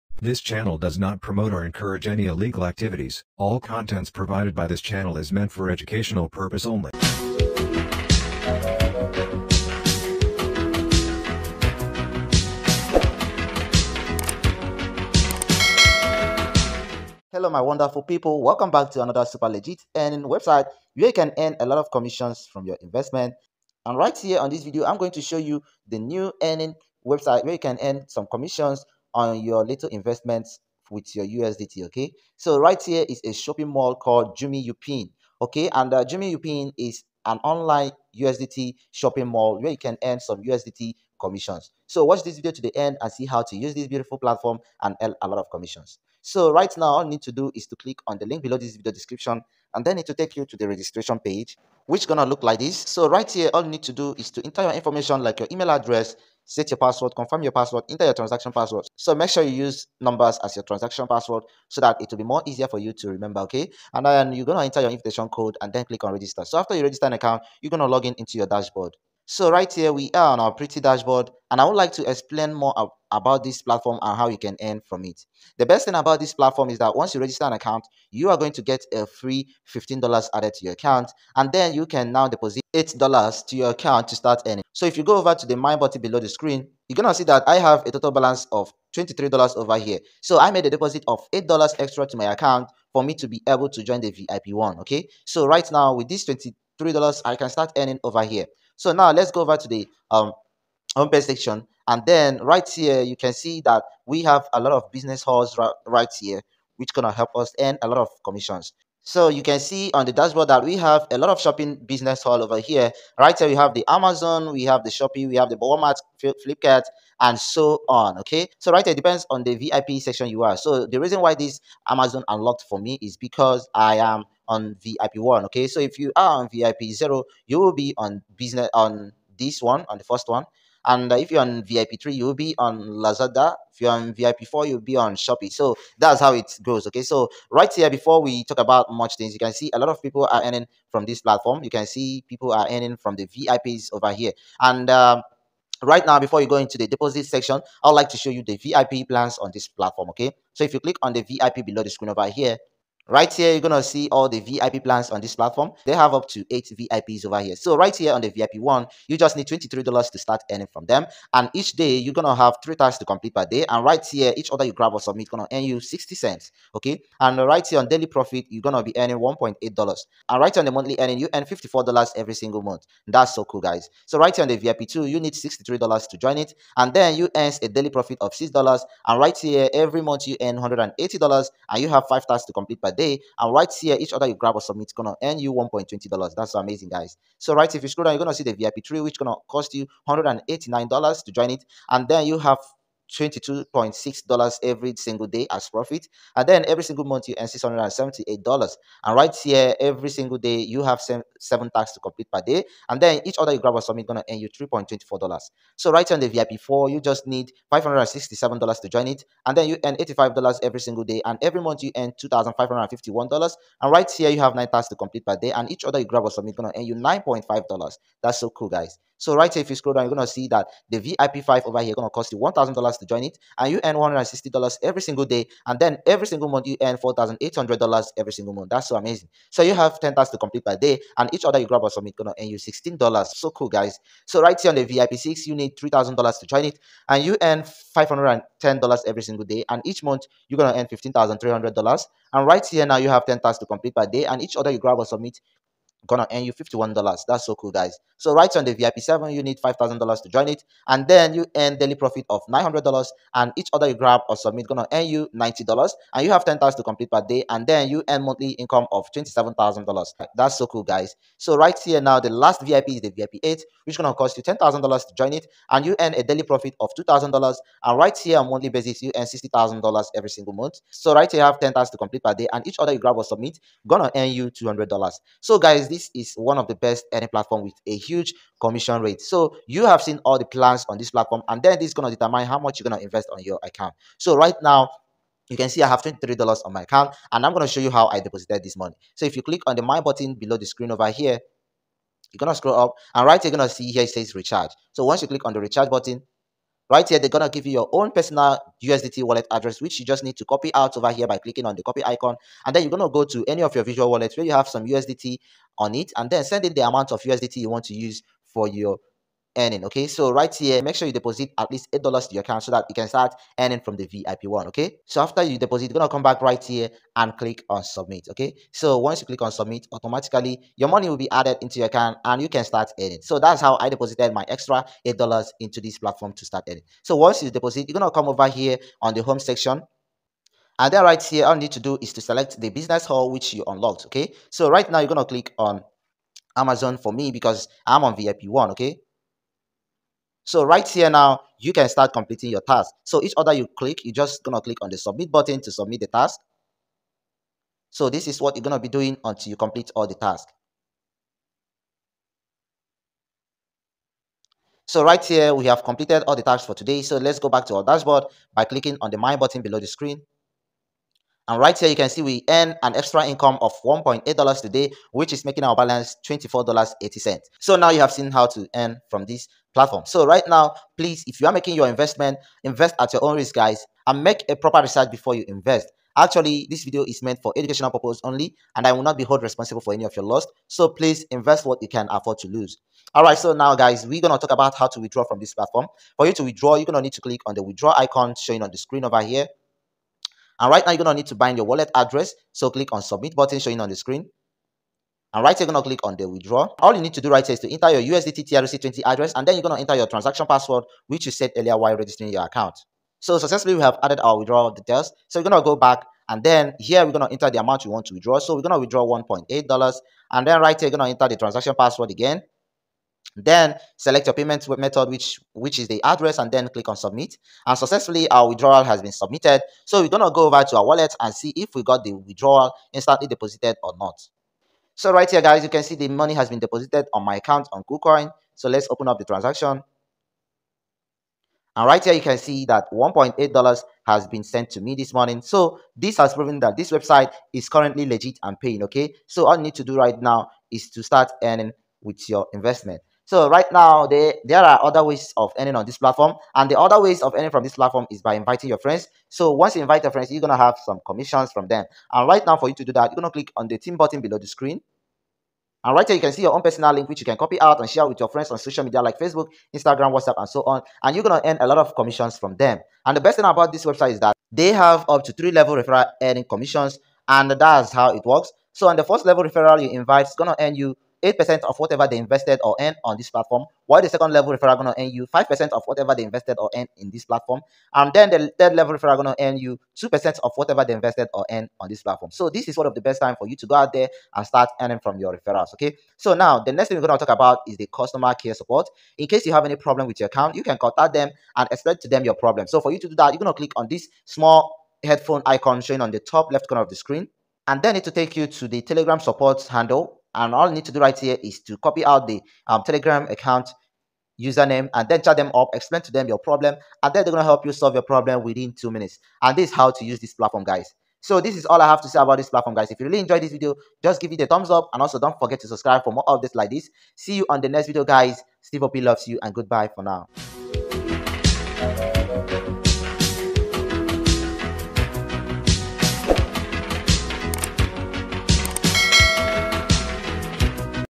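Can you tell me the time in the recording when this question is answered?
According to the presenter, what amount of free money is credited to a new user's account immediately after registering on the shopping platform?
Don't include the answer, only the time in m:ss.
1:19.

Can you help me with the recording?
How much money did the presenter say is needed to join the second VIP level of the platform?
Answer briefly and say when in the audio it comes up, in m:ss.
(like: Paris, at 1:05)
$63, at 2:55.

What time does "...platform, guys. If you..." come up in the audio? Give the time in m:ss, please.
8:32.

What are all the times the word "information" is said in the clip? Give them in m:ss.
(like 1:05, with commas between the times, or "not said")
0:54.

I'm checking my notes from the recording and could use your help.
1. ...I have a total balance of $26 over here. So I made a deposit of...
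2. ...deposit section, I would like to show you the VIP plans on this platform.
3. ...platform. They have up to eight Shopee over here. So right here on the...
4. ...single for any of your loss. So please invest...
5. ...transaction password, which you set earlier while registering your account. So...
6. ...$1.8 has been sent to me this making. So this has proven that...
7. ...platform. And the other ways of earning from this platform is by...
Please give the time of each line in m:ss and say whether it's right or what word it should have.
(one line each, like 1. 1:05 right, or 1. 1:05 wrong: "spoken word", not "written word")
1. 1:27 wrong: "23", not "26"
2. 2:26 right
3. 2:35 wrong: "VIPs", not "Shopee"
4. 6:19 wrong: "responsible", not "single"
5. 6:40 right
6. 7:12 wrong: "morning", not "making"
7. 7:25 right.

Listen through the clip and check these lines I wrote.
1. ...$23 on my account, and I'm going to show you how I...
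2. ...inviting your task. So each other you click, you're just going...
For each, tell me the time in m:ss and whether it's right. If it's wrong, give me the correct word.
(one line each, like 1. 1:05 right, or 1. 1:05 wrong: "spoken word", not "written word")
1. 4:46 right
2. 5:42 wrong: "completing", not "inviting".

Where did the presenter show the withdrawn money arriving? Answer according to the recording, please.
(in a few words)
KuCoin.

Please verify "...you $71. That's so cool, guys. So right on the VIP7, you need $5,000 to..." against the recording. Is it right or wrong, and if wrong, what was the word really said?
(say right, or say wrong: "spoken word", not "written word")
wrong: "51", not "71".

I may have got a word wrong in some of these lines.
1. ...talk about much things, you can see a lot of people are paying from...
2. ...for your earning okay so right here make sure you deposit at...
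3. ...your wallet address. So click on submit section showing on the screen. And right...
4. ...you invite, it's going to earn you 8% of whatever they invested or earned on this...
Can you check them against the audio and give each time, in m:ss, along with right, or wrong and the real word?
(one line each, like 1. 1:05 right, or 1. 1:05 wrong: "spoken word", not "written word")
1. 2:18 wrong: "earning", not "paying"
2. 5:08 right
3. 6:31 wrong: "button", not "section"
4. 7:49 right.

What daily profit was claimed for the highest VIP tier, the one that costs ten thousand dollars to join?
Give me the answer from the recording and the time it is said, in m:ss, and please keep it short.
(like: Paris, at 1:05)
$2,000, at 4:26.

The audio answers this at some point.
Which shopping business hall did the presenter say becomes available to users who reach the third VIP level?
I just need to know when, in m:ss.
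2:12.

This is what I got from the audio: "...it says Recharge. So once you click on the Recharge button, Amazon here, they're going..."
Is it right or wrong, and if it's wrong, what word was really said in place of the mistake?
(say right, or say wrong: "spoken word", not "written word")
wrong: "Right", not "Amazon".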